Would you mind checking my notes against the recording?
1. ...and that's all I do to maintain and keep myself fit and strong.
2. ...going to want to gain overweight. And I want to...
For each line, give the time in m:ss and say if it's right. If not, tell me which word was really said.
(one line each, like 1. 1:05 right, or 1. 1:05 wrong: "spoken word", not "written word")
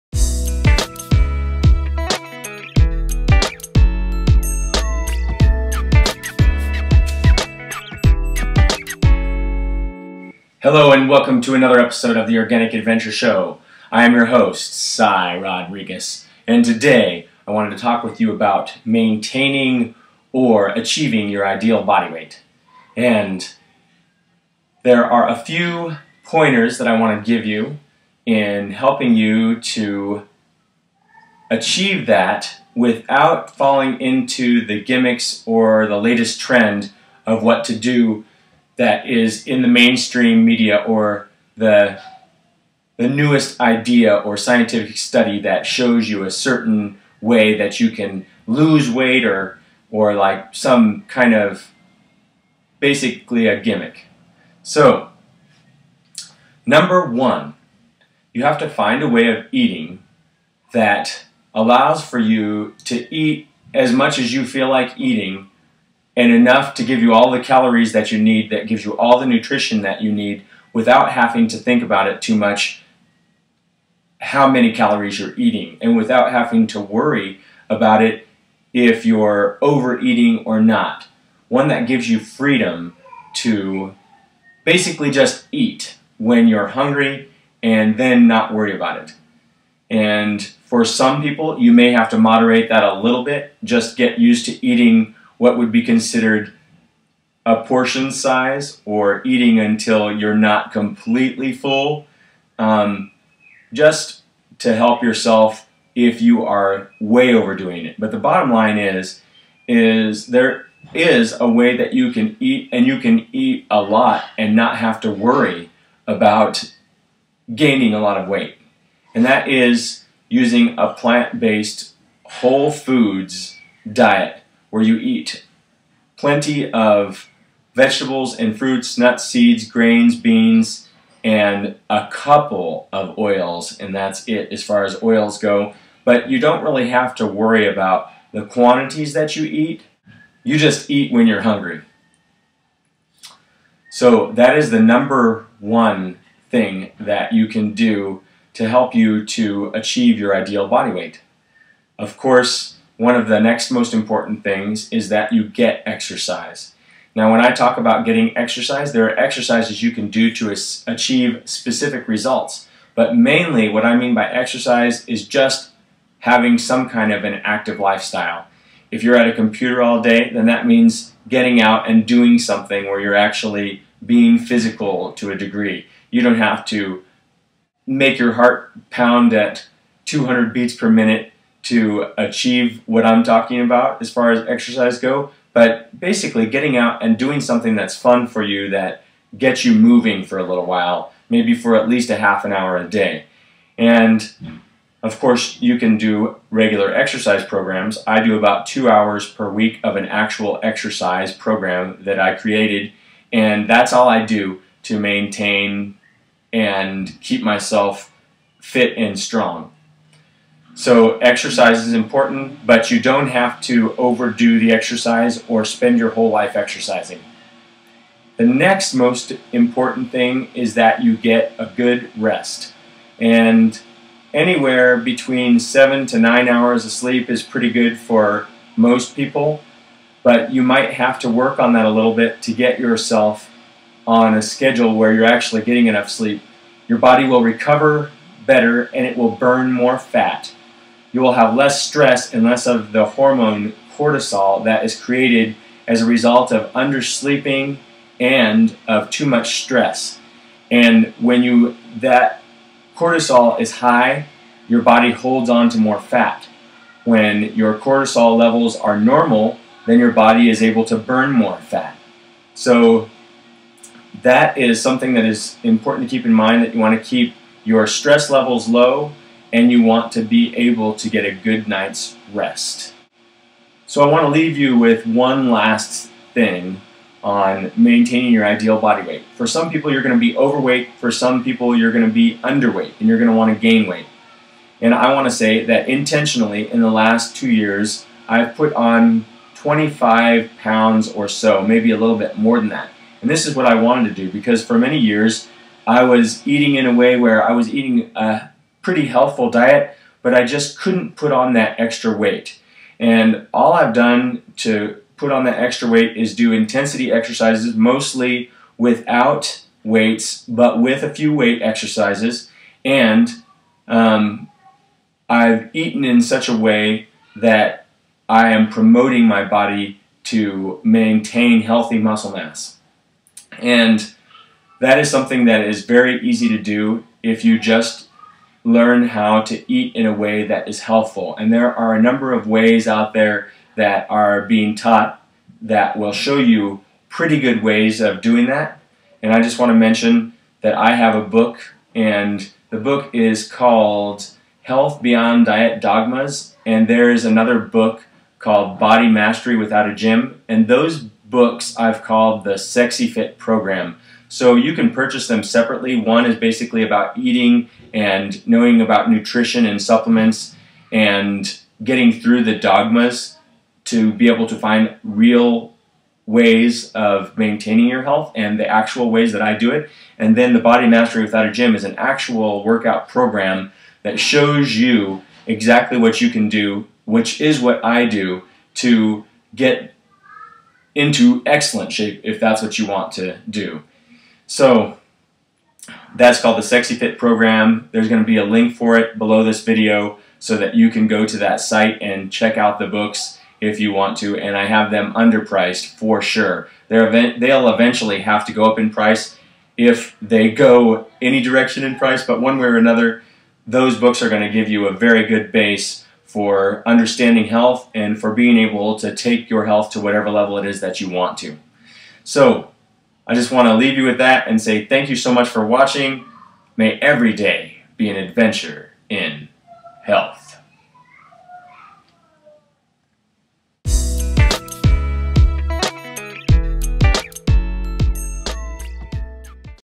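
1. 3:23 right
2. 4:43 wrong: "weight", not "overweight".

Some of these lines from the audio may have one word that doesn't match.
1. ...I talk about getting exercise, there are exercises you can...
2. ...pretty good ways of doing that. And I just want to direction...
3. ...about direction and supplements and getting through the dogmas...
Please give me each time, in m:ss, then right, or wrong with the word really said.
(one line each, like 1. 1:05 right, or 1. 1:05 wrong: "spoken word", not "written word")
1. 2:37 right
2. 5:37 wrong: "mention", not "direction"
3. 5:58 wrong: "nutrition", not "direction".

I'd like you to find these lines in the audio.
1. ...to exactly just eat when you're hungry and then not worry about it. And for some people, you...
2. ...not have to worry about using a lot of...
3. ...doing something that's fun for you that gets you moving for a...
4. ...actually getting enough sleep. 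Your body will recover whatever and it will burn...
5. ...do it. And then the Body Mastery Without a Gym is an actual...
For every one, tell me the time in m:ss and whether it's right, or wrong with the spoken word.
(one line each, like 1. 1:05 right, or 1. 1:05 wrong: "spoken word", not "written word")
1. 1:23 wrong: "basically", not "exactly"
2. 1:54 wrong: "gaining", not "using"
3. 3:07 right
4. 3:55 wrong: "better", not "whatever"
5. 6:09 right.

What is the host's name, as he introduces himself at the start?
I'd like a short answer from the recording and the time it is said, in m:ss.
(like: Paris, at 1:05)
Cy Rodriguez, at 0:14.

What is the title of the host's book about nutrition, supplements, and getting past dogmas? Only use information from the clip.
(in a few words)
Health Beyond Diet Dogmas.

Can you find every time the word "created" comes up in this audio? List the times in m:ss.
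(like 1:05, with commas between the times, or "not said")
3:22, 4:04.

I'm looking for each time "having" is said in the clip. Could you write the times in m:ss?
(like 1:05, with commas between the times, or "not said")
1:11, 1:16, 2:46.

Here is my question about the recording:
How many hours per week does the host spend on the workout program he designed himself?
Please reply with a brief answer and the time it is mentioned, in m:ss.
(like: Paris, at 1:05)
2, at 3:18.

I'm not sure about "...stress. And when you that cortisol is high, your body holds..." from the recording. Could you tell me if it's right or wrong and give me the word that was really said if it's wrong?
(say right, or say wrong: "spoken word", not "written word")
right.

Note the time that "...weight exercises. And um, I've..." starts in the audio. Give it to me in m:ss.
5:11.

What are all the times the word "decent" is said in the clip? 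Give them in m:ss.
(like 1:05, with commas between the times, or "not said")
not said.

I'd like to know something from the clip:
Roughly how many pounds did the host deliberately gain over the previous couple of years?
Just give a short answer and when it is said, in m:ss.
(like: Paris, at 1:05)
25, at 4:49.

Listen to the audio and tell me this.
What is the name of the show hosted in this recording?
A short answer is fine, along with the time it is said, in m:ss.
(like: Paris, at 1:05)
Organic Adventure Show, at 0:12.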